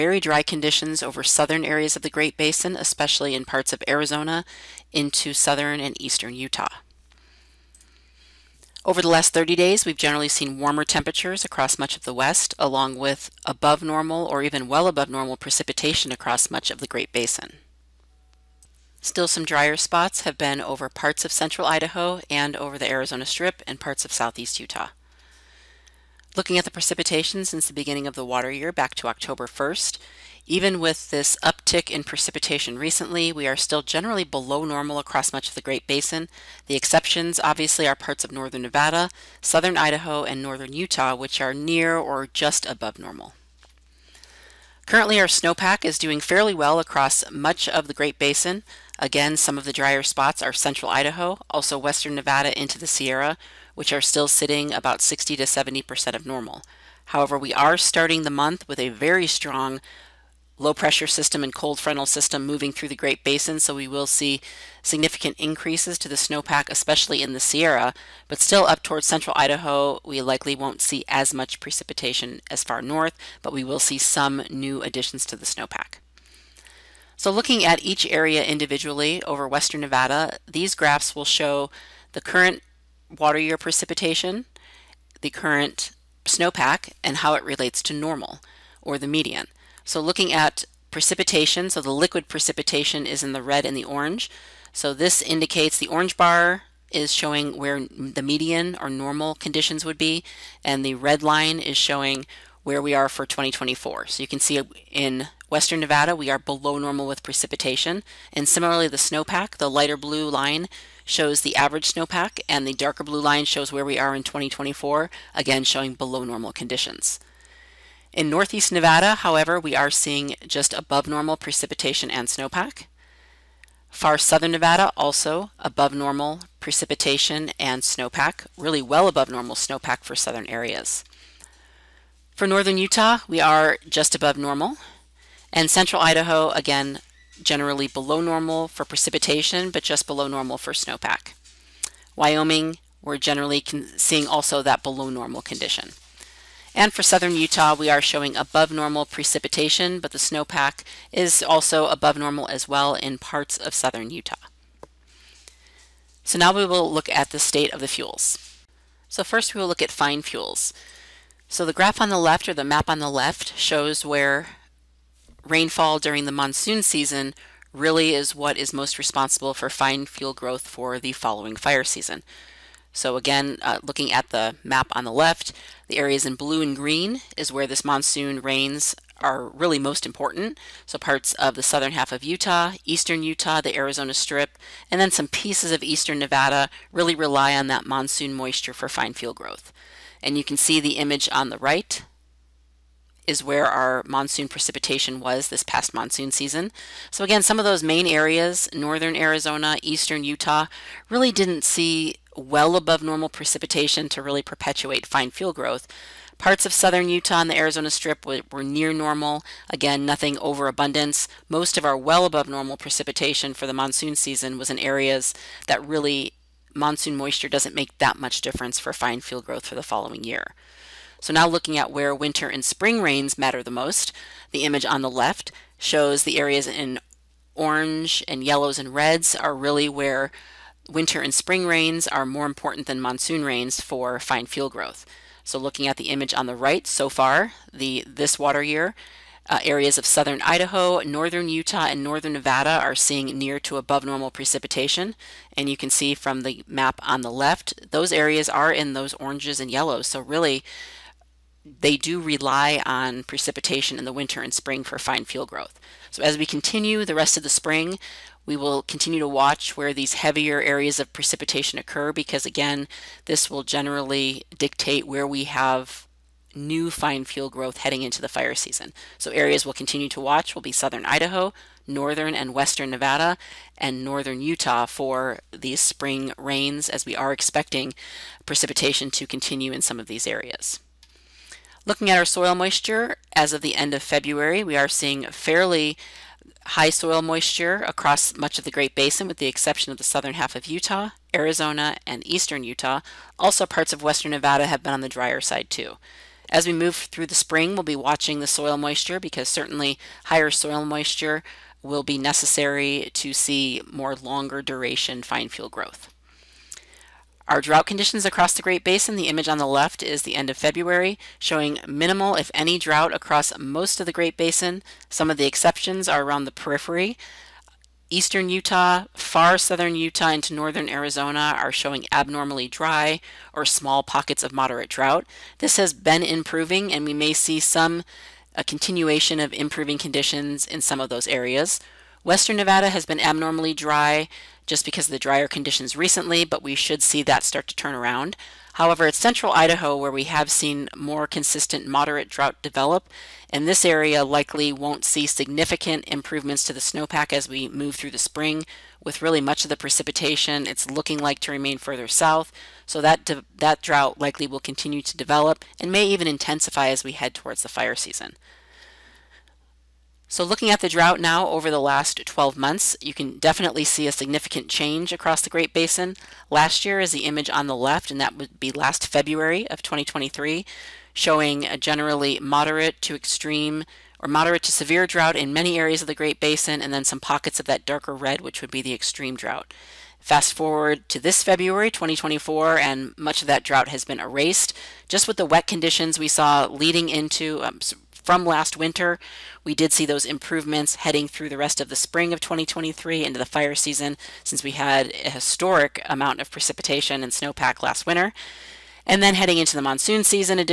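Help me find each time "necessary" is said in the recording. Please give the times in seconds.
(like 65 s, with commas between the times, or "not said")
302 s.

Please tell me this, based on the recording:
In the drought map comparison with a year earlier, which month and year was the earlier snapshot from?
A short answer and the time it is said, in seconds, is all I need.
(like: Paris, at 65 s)
February 2023, at 369 s.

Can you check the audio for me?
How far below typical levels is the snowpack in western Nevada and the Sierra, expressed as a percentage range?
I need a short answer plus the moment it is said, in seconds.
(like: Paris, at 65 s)
60 to 70%, at 54 s.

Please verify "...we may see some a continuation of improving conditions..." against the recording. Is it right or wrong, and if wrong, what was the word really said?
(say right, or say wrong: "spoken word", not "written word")
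right.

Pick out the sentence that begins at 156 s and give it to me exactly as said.
So now we will look at the state of the fuels.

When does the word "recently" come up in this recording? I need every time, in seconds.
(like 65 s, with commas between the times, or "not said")
32 s, 335 s.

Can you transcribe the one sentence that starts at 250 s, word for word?
So really, they do rely on precipitation in the winter and spring for fine fuel growth.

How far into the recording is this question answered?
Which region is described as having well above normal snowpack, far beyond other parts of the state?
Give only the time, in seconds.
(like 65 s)
123 s.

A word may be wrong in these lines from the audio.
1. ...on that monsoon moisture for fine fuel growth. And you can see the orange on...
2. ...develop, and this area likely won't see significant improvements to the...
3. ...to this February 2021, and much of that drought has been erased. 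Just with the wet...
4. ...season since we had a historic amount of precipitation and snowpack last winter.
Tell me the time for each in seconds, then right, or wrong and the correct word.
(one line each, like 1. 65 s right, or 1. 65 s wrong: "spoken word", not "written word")
1. 187 s wrong: "image", not "orange"
2. 342 s right
3. 381 s wrong: "2024", not "2021"
4. 393 s right.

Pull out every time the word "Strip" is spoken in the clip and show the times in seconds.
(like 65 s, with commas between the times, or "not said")
23 s, 184 s, 207 s.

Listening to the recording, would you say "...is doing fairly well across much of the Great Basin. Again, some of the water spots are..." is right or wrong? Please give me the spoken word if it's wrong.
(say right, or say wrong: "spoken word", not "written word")
wrong: "drier", not "water".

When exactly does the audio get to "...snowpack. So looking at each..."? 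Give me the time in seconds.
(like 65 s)
75 s.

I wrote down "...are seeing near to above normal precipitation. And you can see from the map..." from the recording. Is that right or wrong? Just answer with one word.
right.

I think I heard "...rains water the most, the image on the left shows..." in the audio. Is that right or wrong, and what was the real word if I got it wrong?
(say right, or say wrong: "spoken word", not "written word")
wrong: "matter", not "water".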